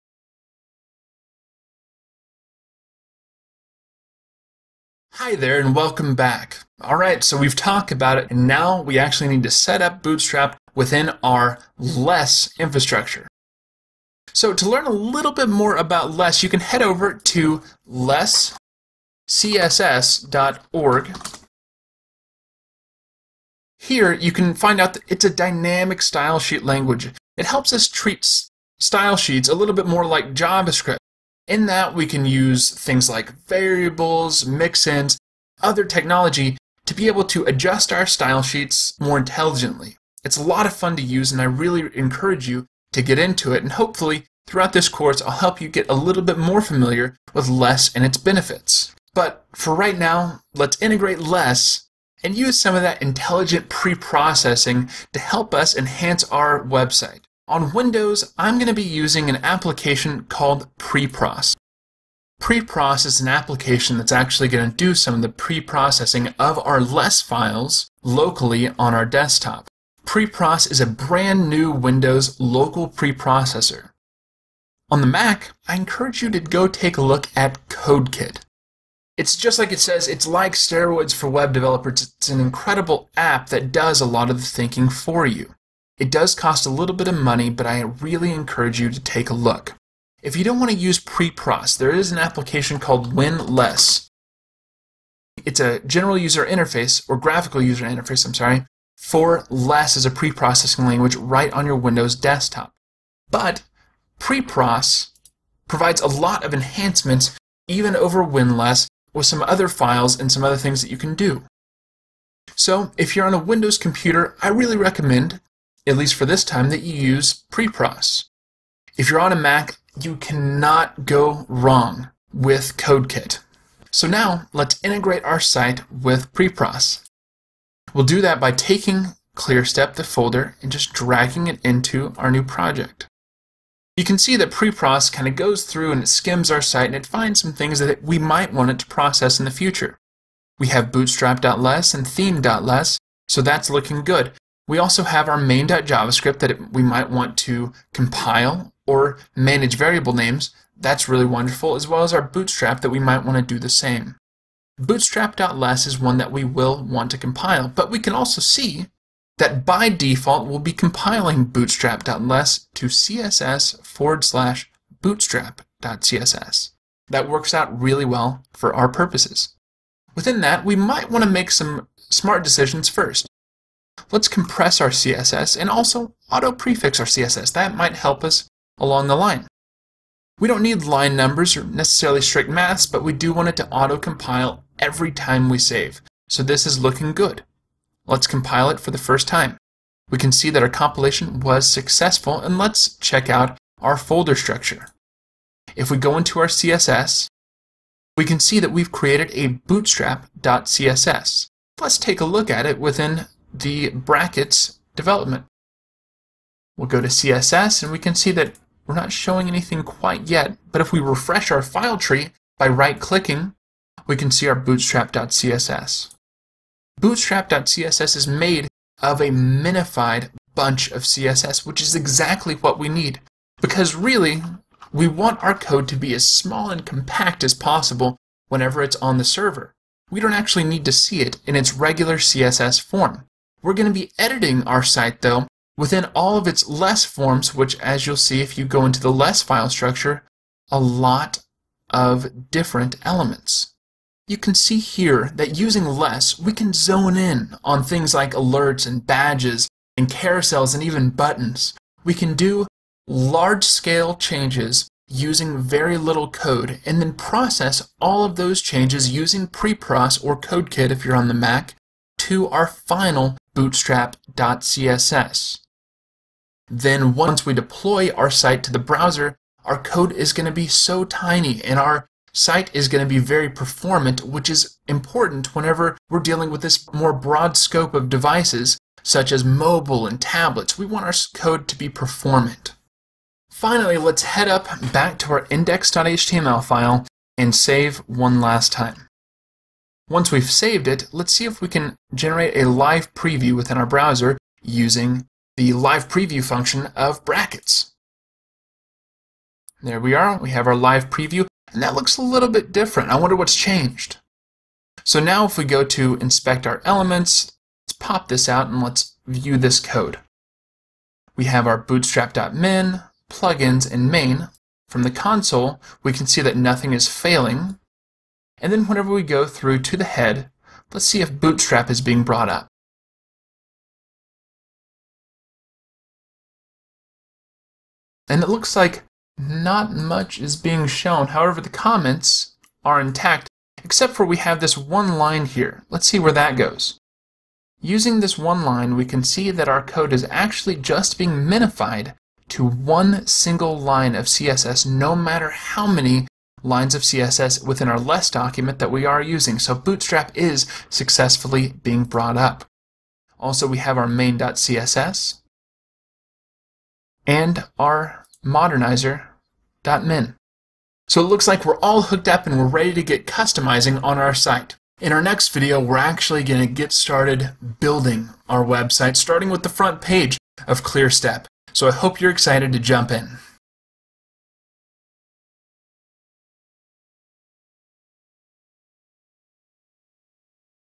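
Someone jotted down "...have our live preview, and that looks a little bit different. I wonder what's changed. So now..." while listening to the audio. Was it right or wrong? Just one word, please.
right.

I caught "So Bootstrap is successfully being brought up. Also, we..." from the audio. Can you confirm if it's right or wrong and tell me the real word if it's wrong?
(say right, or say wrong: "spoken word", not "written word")
right.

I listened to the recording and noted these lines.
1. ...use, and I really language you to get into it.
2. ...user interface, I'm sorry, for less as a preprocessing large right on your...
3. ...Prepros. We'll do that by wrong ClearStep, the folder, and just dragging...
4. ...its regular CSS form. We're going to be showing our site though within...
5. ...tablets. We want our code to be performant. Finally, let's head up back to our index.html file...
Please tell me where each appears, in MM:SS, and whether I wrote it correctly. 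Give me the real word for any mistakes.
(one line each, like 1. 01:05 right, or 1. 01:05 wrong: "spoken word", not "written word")
1. 00:41 wrong: "encourage", not "language"
2. 01:37 wrong: "language", not "large"
3. 02:06 wrong: "taking", not "wrong"
4. 03:51 wrong: "editing", not "showing"
5. 04:40 right.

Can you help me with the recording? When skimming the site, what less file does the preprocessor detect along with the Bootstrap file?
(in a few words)
theme.less.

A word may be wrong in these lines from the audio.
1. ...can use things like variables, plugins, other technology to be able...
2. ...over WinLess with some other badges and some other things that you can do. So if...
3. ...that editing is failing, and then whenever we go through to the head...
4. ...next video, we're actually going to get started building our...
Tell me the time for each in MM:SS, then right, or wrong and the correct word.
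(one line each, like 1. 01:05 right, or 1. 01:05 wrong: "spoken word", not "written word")
1. 00:32 wrong: "mixins", not "plugins"
2. 01:47 wrong: "files", not "badges"
3. 05:16 wrong: "nothing", not "editing"
4. 06:05 right.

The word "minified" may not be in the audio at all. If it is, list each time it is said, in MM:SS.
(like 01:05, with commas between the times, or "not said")
03:39, 05:41.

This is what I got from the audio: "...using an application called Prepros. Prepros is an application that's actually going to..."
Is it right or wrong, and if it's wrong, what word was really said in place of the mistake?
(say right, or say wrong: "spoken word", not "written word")
right.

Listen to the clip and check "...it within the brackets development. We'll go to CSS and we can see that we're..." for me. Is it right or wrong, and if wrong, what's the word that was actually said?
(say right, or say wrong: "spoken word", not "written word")
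right.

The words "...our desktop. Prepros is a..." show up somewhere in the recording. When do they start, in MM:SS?
01:08.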